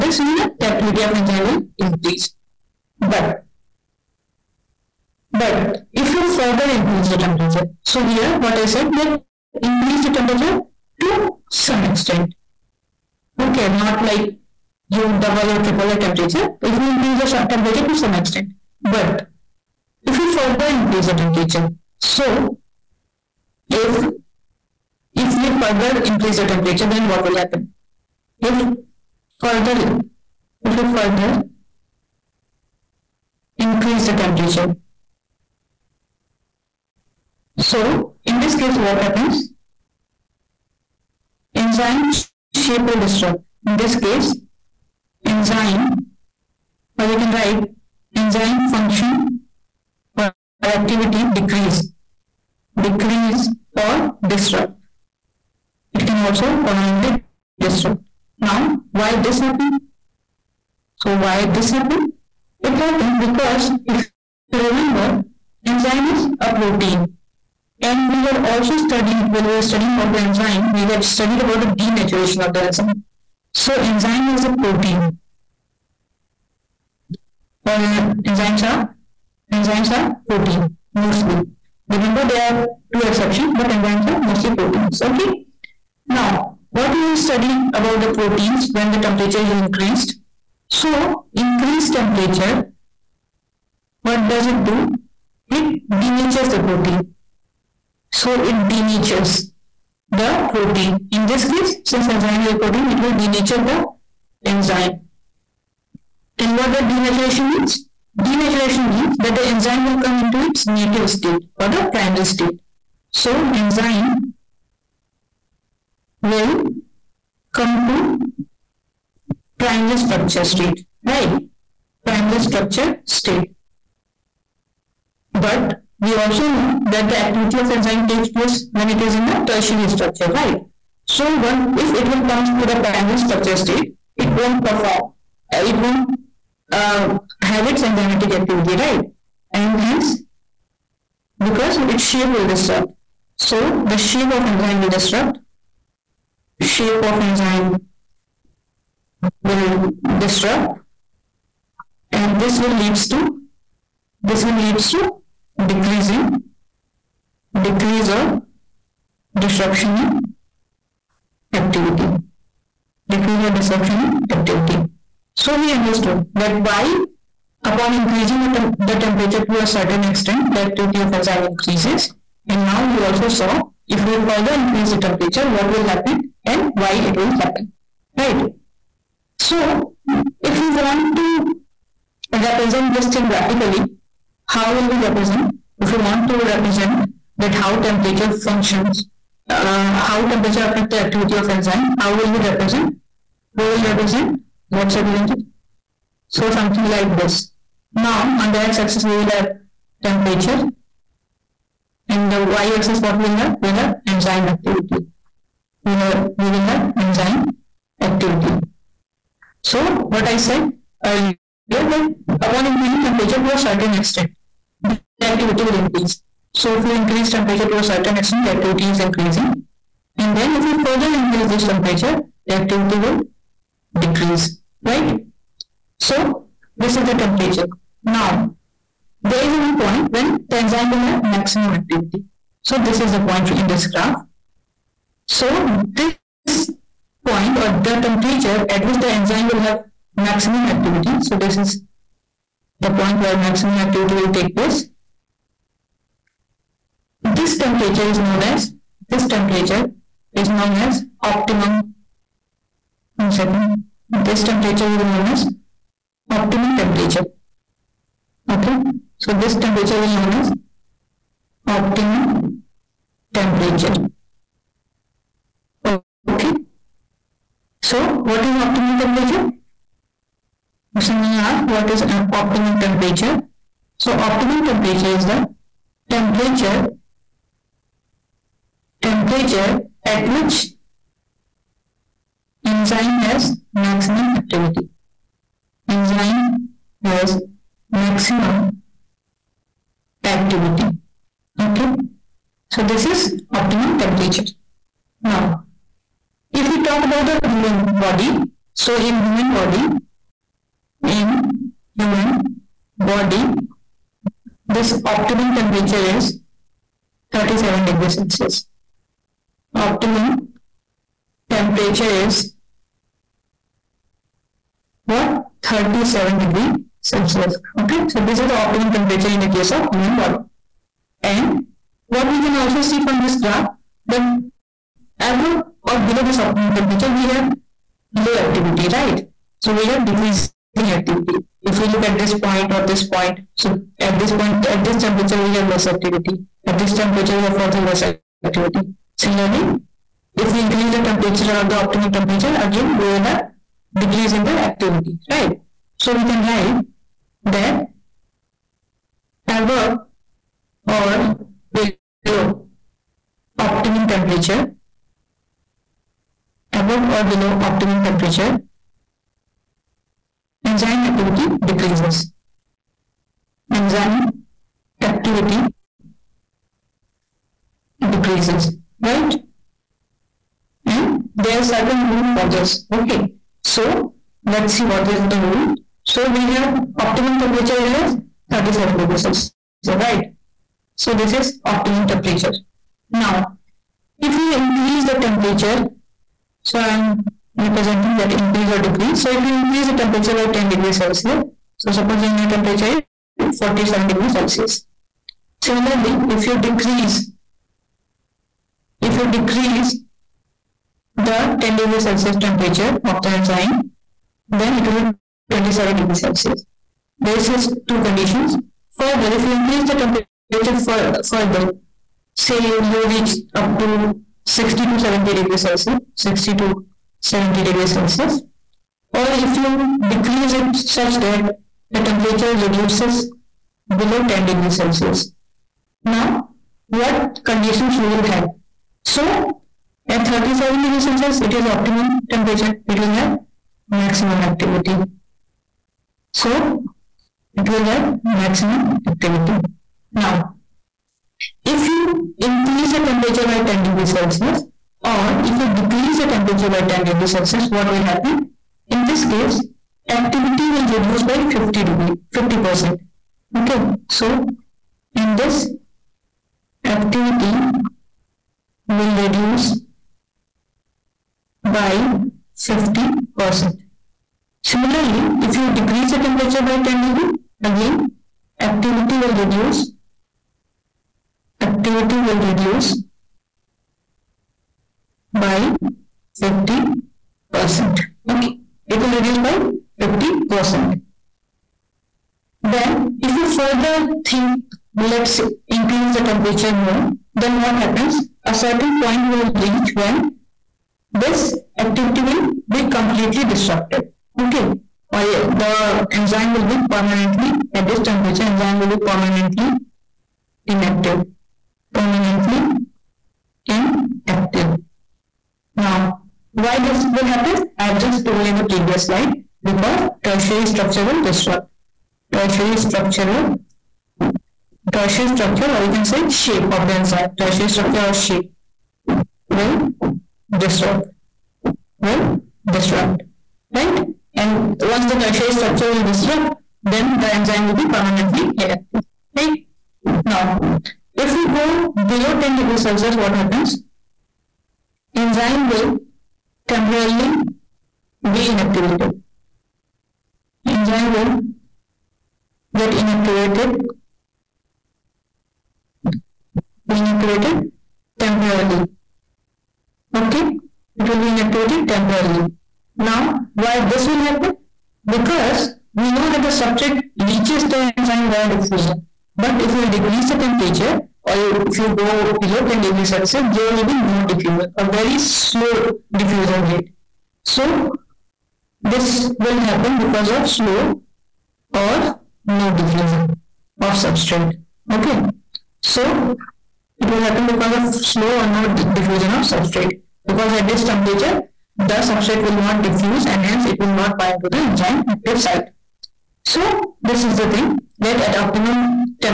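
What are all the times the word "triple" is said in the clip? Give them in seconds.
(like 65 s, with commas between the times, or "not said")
15 s.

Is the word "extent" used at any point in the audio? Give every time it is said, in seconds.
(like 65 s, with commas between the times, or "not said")
11 s, 18 s, 170 s, 213 s, 218 s.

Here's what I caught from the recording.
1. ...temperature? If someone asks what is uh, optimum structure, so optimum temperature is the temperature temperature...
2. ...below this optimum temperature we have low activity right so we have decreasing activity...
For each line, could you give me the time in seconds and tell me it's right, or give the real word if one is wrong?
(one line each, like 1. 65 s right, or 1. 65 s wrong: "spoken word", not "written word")
1. 268 s wrong: "temperature", not "structure"
2. 326 s right.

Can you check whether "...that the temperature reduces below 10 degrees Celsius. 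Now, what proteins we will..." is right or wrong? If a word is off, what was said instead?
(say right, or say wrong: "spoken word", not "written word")
wrong: "conditions", not "proteins".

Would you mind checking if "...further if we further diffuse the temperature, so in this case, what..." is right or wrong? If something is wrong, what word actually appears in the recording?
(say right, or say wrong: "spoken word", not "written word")
wrong: "increase", not "diffuse".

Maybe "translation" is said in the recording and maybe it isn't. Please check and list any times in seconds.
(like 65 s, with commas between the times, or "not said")
not said.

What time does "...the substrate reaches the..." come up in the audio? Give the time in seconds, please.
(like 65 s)
556 s.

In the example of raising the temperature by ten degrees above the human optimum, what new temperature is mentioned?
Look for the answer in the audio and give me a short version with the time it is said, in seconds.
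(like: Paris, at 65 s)
47 degrees Celsius, at 393 s.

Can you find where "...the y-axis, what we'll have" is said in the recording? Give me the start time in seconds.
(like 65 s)
202 s.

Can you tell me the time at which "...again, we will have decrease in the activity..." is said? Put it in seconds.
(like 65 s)
342 s.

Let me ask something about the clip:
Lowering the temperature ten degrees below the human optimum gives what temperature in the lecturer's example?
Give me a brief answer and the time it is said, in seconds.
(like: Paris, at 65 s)
27 degrees Celsius, at 405 s.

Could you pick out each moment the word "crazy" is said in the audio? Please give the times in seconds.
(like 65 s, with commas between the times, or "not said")
not said.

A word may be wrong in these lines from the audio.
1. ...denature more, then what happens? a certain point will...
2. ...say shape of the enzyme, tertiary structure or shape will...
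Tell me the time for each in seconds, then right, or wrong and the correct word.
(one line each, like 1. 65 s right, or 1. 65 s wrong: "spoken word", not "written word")
1. 486 s wrong: "temperature", not "denature"
2. 516 s right.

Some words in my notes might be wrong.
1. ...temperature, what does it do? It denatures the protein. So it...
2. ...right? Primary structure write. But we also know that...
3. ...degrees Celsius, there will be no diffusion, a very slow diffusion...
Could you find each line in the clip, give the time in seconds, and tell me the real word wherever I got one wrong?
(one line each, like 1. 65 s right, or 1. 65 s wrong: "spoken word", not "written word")
1. 91 s right
2. 121 s wrong: "state", not "write"
3. 562 s right.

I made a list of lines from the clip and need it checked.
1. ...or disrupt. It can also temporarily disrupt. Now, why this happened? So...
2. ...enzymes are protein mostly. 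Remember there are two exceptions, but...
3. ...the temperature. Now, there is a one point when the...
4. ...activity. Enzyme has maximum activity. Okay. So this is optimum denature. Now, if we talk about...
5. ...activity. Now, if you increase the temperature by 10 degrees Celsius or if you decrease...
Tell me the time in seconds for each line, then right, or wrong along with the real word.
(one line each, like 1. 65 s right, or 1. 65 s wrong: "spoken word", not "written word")
1. 53 s wrong: "permanently", not "temporarily"
2. 79 s right
3. 227 s right
4. 284 s wrong: "temperature", not "denature"
5. 439 s right.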